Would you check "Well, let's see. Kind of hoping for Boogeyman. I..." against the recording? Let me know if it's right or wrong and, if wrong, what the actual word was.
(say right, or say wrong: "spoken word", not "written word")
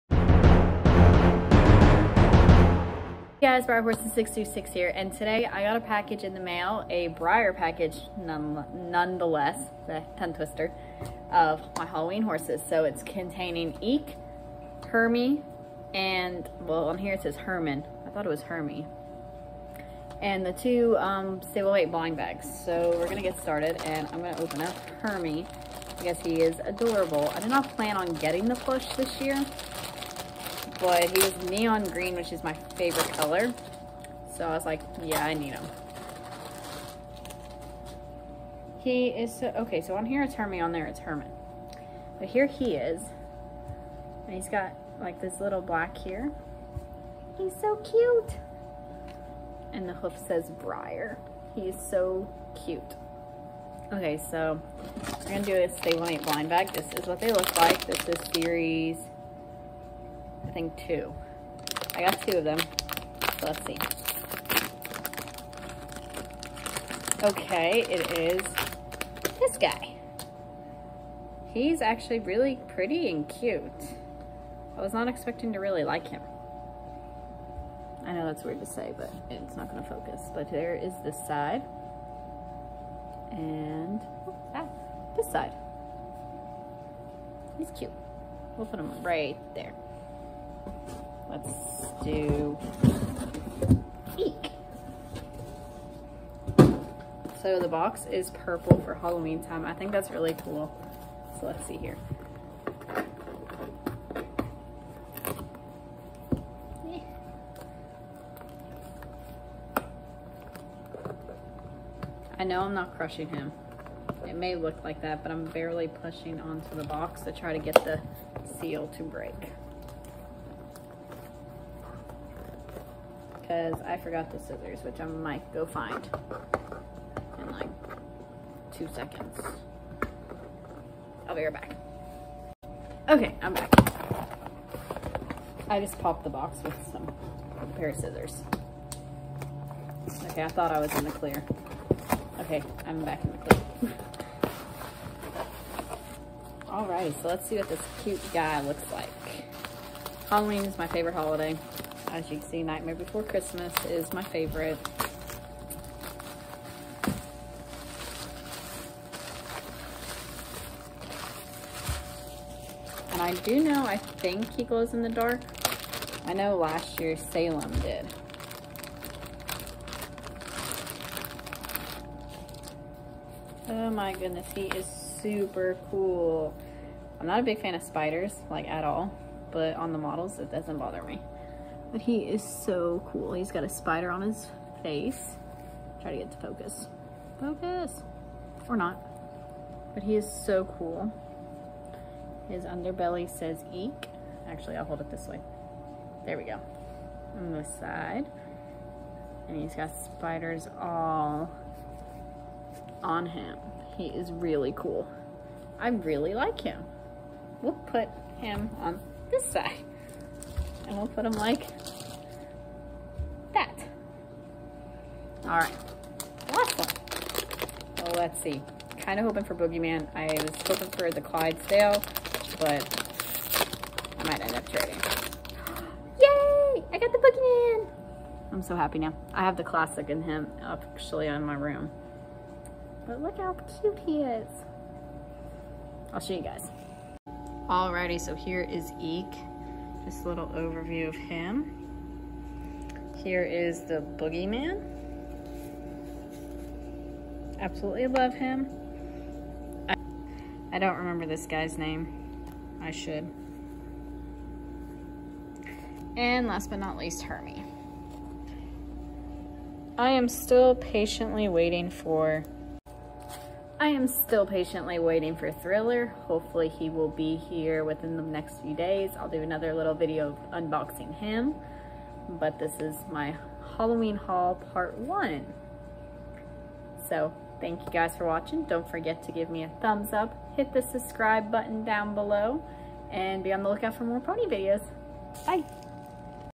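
right.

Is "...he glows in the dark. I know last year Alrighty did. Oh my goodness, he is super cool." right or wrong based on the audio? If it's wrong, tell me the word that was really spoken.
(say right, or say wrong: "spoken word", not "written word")
wrong: "Salem", not "Alrighty".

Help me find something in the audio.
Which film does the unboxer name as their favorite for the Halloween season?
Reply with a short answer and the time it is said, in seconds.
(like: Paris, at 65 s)
Nightmare Before Christmas, at 152 s.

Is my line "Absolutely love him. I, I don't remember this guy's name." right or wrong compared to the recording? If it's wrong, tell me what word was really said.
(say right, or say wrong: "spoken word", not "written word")
right.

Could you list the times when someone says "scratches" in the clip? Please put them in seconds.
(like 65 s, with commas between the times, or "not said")
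not said.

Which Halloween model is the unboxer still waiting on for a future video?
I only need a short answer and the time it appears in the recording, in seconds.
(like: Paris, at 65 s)
Thriller, at 265 s.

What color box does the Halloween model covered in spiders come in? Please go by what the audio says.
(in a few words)
Purple.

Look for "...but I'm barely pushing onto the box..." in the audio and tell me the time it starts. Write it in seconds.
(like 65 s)
115 s.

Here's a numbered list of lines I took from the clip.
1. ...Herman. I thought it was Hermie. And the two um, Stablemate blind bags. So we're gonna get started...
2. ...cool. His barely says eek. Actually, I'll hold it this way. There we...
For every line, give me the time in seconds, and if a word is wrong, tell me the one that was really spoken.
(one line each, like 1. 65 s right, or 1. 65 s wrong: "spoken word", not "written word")
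1. 17 s right
2. 190 s wrong: "underbelly", not "barely".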